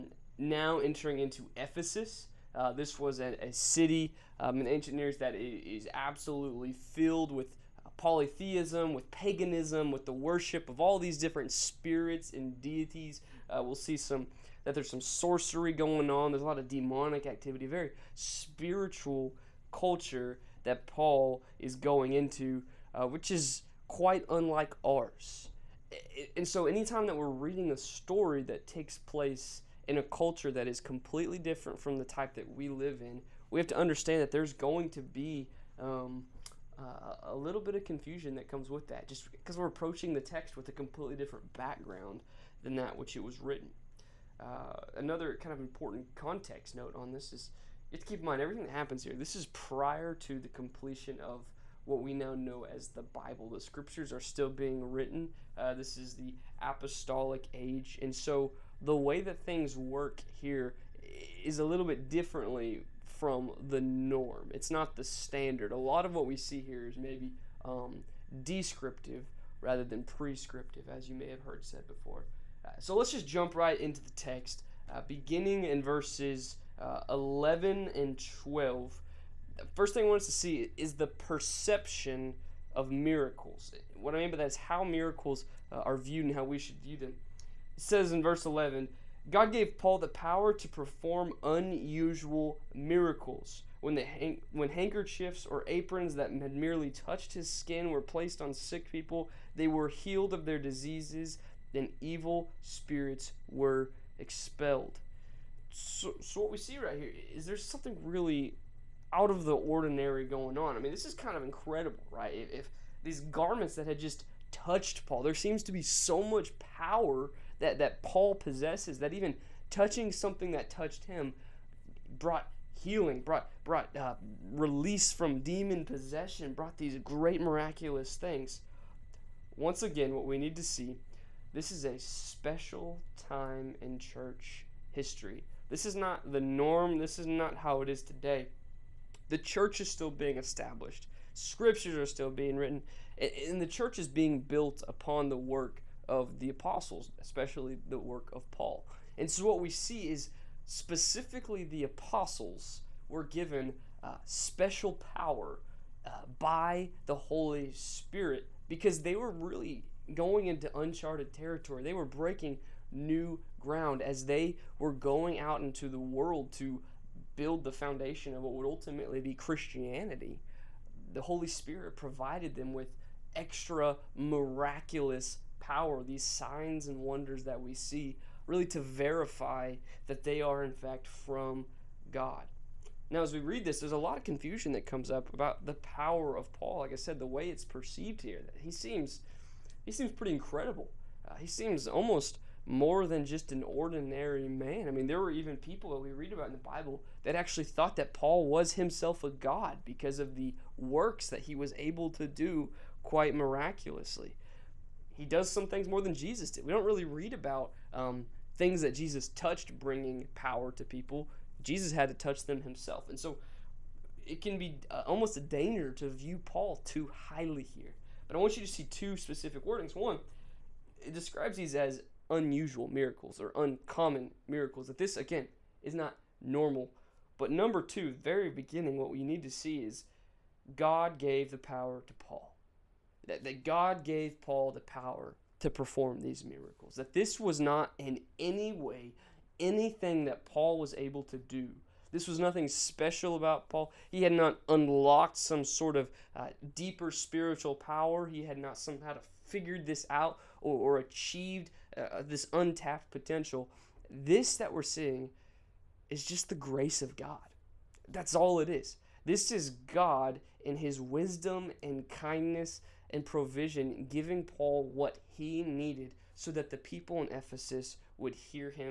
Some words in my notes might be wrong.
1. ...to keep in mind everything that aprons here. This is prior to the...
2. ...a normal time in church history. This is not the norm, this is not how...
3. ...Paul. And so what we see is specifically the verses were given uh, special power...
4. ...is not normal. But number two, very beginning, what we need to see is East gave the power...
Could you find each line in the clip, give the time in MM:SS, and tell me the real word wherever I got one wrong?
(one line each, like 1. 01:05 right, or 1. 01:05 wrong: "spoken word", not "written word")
1. 00:48 wrong: "happens", not "aprons"
2. 02:11 wrong: "special", not "normal"
3. 02:28 wrong: "apostles", not "verses"
4. 03:45 wrong: "God", not "East".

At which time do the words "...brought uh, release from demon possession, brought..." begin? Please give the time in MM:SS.
02:03.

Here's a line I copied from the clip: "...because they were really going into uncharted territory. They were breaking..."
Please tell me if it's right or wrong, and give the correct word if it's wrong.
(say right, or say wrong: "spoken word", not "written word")
right.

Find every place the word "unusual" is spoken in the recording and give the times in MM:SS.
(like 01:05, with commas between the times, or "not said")
01:31, 03:42.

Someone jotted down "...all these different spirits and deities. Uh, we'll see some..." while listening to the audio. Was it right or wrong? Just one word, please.
right.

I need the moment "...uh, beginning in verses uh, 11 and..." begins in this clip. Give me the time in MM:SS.
01:14.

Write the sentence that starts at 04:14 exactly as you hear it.
This that we're seeing is just the grace of God.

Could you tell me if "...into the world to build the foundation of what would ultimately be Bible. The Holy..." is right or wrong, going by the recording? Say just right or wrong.
wrong.